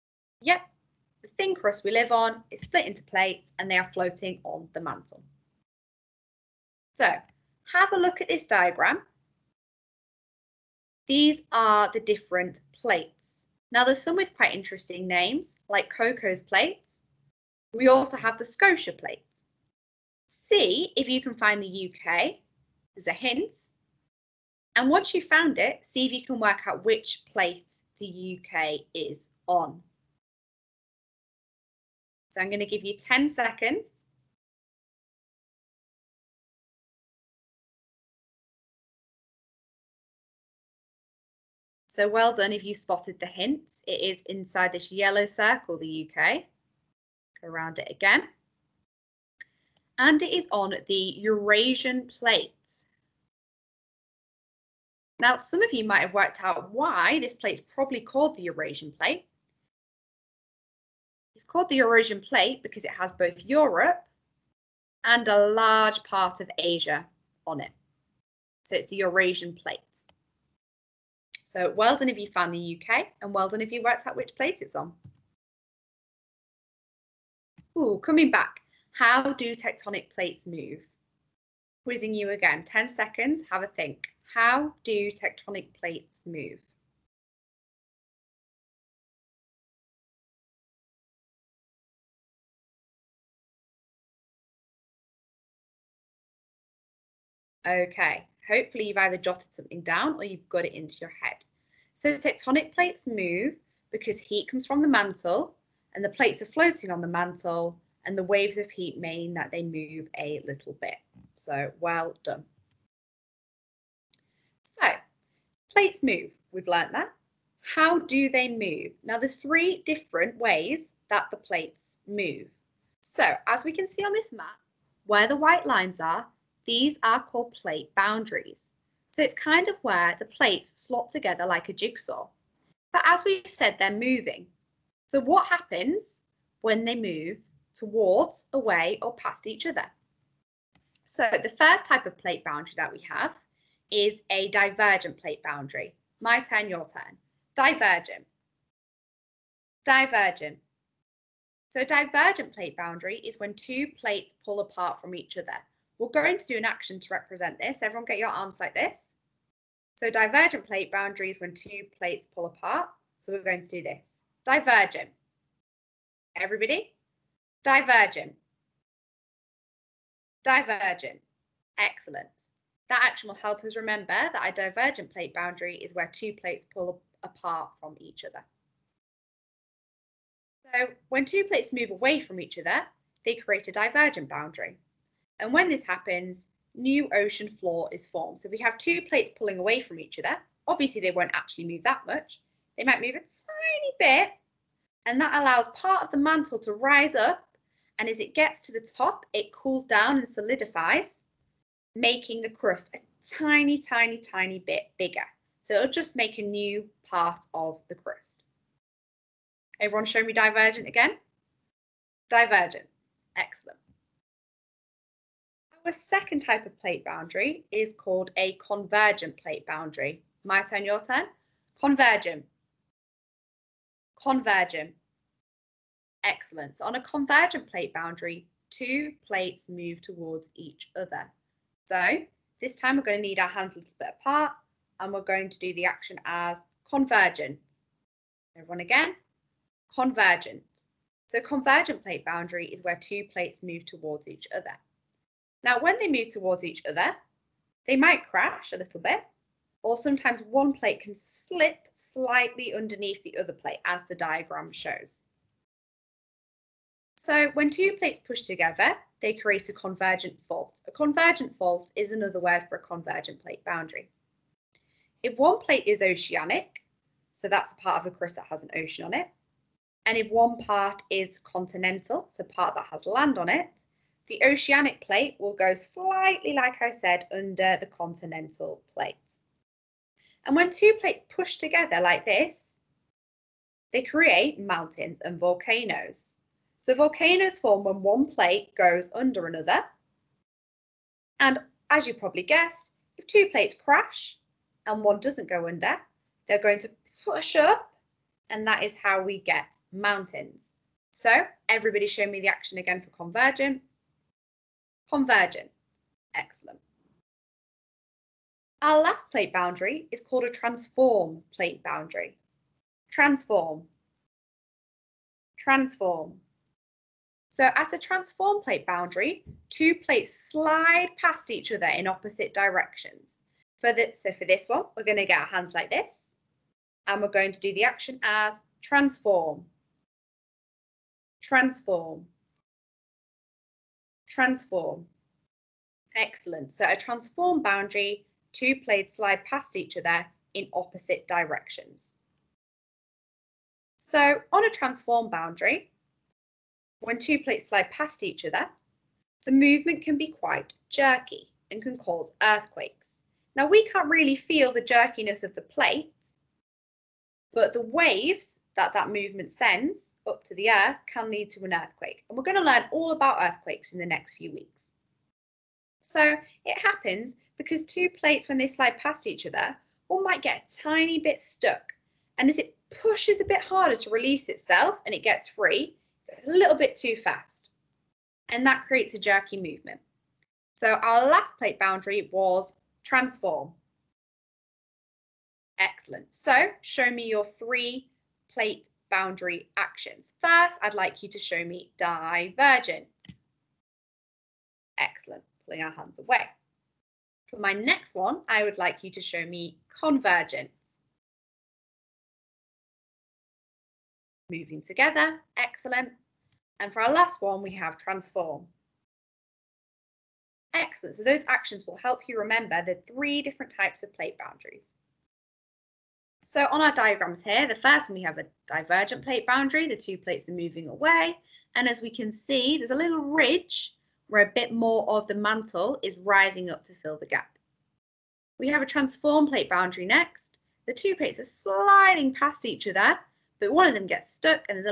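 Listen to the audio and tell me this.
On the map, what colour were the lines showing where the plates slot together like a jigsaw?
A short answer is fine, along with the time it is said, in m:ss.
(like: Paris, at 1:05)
White, at 2:05.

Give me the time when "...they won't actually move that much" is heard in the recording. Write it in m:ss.
3:11.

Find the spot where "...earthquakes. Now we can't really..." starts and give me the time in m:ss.
5:52.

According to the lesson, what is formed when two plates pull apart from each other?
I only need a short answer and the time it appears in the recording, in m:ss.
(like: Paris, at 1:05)
New ocean floor, at 3:06.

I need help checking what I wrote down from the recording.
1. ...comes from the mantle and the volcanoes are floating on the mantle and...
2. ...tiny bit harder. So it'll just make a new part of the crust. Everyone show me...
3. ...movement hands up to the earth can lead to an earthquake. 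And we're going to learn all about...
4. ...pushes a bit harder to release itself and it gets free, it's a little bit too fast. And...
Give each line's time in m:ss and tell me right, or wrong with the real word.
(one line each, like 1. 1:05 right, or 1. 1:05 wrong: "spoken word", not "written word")
1. 1:44 wrong: "plates", not "volcanoes"
2. 3:24 wrong: "bigger", not "harder"
3. 5:59 wrong: "sends", not "hands"
4. 6:13 right.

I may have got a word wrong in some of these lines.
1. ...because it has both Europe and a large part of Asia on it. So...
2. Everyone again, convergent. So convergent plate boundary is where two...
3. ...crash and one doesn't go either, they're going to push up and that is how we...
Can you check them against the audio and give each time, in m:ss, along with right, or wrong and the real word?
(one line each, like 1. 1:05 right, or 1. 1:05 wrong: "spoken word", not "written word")
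1. 1:02 right
2. 3:58 right
3. 4:53 wrong: "under", not "either".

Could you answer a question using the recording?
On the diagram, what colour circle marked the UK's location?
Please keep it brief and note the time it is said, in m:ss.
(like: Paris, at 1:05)
Yellow, at 0:44.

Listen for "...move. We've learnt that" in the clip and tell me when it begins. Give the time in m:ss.
1:56.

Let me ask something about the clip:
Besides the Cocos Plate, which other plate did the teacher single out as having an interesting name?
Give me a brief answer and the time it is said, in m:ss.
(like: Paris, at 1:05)
Scotia Plate, at 0:18.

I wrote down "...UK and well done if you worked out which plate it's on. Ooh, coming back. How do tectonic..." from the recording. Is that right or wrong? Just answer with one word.
right.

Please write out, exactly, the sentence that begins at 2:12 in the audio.
But as we've said, they're moving.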